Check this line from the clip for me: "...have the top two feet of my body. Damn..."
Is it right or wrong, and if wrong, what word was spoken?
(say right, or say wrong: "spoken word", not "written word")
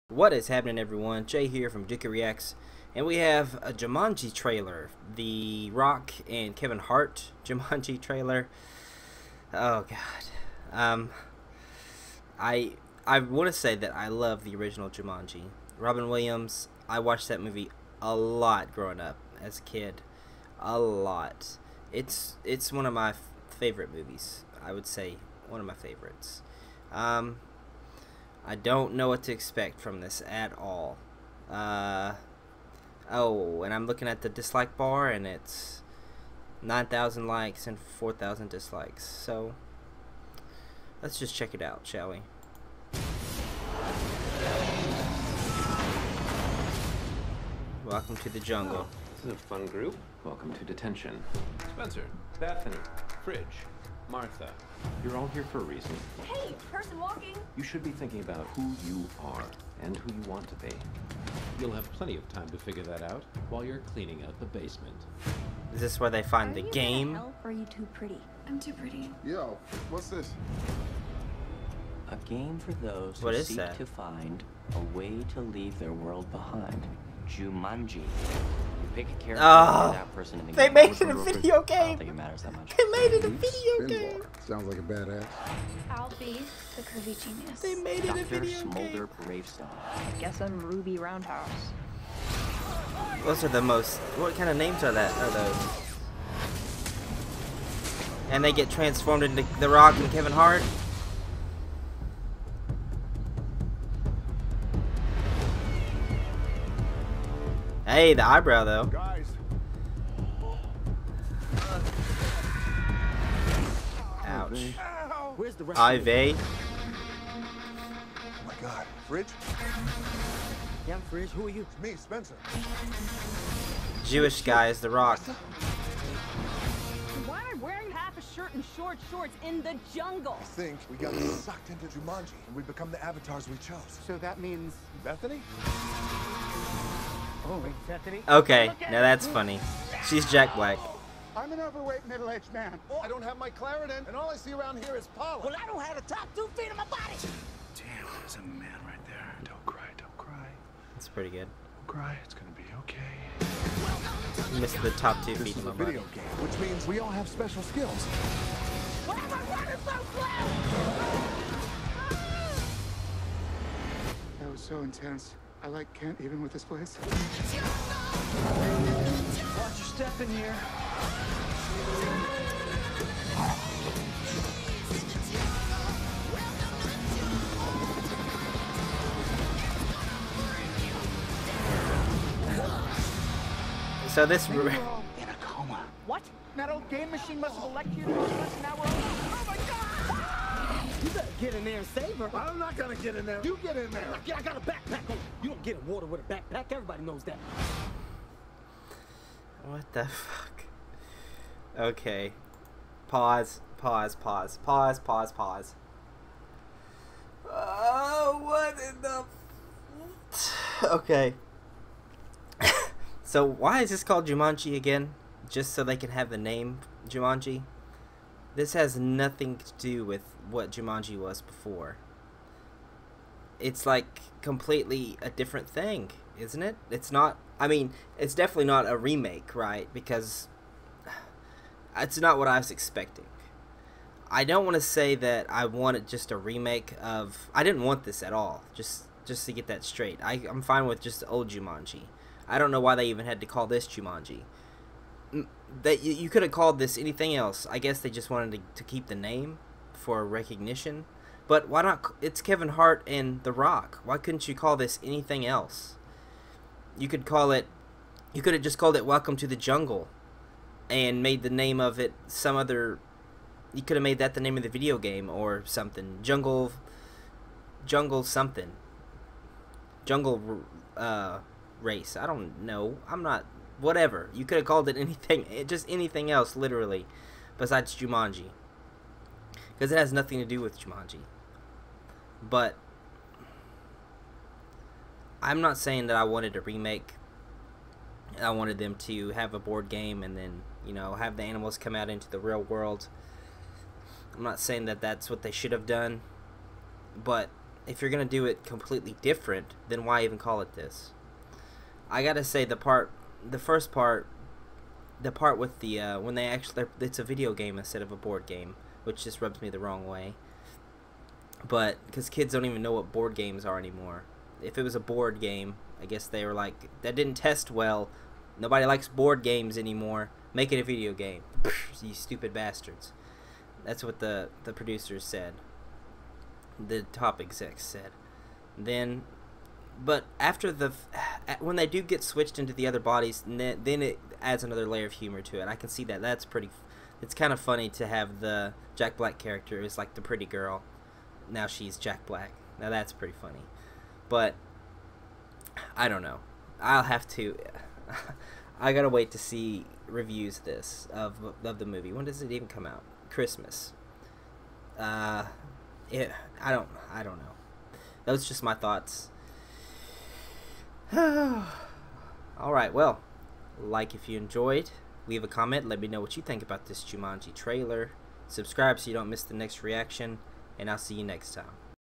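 right.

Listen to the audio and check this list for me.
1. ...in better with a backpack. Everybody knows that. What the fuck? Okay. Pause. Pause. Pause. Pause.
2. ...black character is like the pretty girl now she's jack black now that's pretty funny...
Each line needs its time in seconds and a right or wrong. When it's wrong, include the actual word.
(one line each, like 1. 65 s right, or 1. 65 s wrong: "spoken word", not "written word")
1. 195 s wrong: "water", not "better"
2. 339 s right.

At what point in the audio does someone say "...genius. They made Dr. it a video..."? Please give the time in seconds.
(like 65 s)
87 s.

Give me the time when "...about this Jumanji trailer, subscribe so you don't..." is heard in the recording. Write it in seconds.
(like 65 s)
366 s.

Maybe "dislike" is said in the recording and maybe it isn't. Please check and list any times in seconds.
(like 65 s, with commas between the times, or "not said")
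34 s, 38 s.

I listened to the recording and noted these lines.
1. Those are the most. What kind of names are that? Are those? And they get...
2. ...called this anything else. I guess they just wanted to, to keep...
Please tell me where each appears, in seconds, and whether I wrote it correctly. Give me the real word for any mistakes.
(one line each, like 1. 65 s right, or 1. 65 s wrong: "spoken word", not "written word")
1. 93 s right
2. 246 s right.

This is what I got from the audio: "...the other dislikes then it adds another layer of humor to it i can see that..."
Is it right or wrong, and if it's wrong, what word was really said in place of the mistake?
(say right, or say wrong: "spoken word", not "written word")
wrong: "bodies", not "dislikes".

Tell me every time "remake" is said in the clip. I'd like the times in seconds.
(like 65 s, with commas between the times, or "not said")
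228 s, 236 s, 286 s.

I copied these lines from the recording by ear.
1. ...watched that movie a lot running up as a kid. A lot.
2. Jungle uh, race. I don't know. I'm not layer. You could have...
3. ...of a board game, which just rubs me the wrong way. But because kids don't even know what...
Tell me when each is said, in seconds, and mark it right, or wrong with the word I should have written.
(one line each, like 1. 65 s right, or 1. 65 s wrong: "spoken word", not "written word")
1. 16 s wrong: "growing", not "running"
2. 270 s wrong: "whatever", not "layer"
3. 308 s right.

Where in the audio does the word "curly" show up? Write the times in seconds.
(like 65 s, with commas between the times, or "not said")
not said.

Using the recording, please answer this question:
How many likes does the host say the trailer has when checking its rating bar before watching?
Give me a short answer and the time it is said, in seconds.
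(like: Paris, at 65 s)
9,000, at 36 s.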